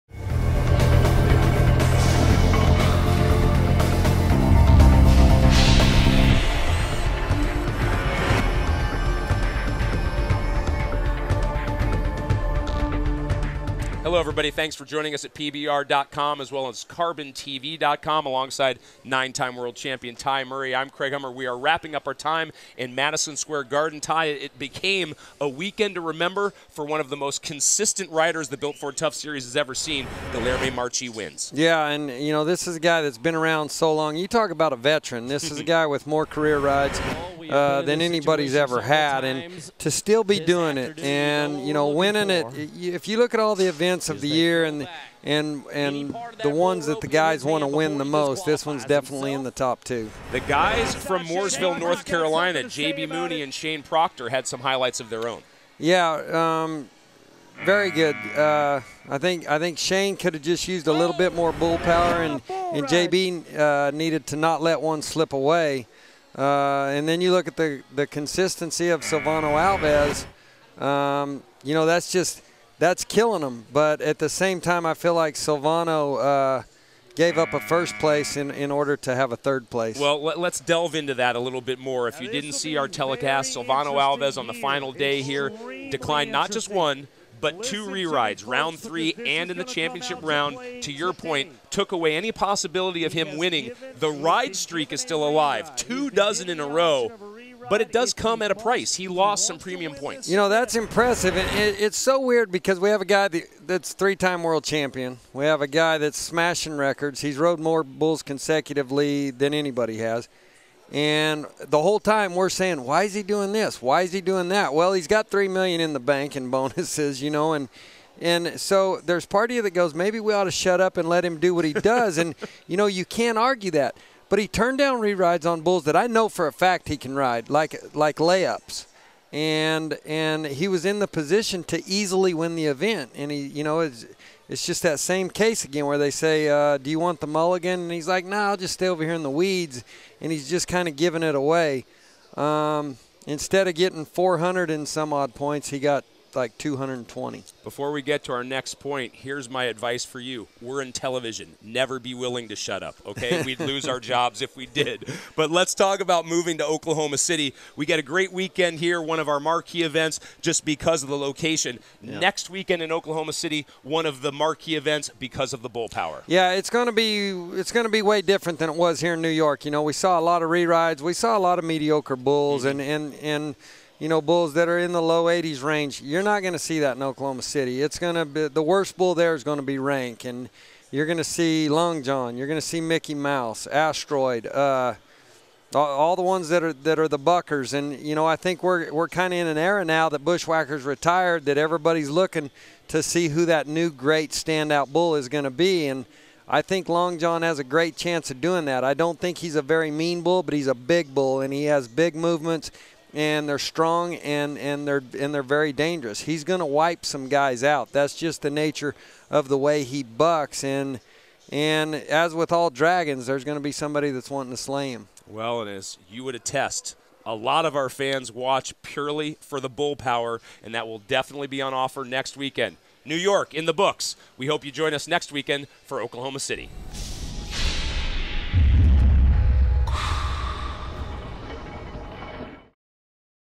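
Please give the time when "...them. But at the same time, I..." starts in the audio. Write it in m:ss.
1:13.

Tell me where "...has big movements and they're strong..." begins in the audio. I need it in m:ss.
3:21.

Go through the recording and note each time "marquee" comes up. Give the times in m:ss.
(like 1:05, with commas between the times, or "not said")
2:39, 2:44.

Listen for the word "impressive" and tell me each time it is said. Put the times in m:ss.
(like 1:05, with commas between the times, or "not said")
1:40.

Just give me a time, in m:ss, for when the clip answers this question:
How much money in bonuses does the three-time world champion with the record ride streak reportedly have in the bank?
1:55.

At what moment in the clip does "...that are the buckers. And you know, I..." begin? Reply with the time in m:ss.
3:06.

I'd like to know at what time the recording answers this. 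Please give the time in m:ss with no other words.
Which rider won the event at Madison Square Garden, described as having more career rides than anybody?
0:30.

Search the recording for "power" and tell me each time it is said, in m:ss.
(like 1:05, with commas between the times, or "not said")
1:01, 2:45, 3:39.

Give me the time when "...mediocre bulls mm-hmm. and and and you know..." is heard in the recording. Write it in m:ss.
2:51.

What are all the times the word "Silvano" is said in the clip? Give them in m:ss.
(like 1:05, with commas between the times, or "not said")
1:09, 1:15, 1:23.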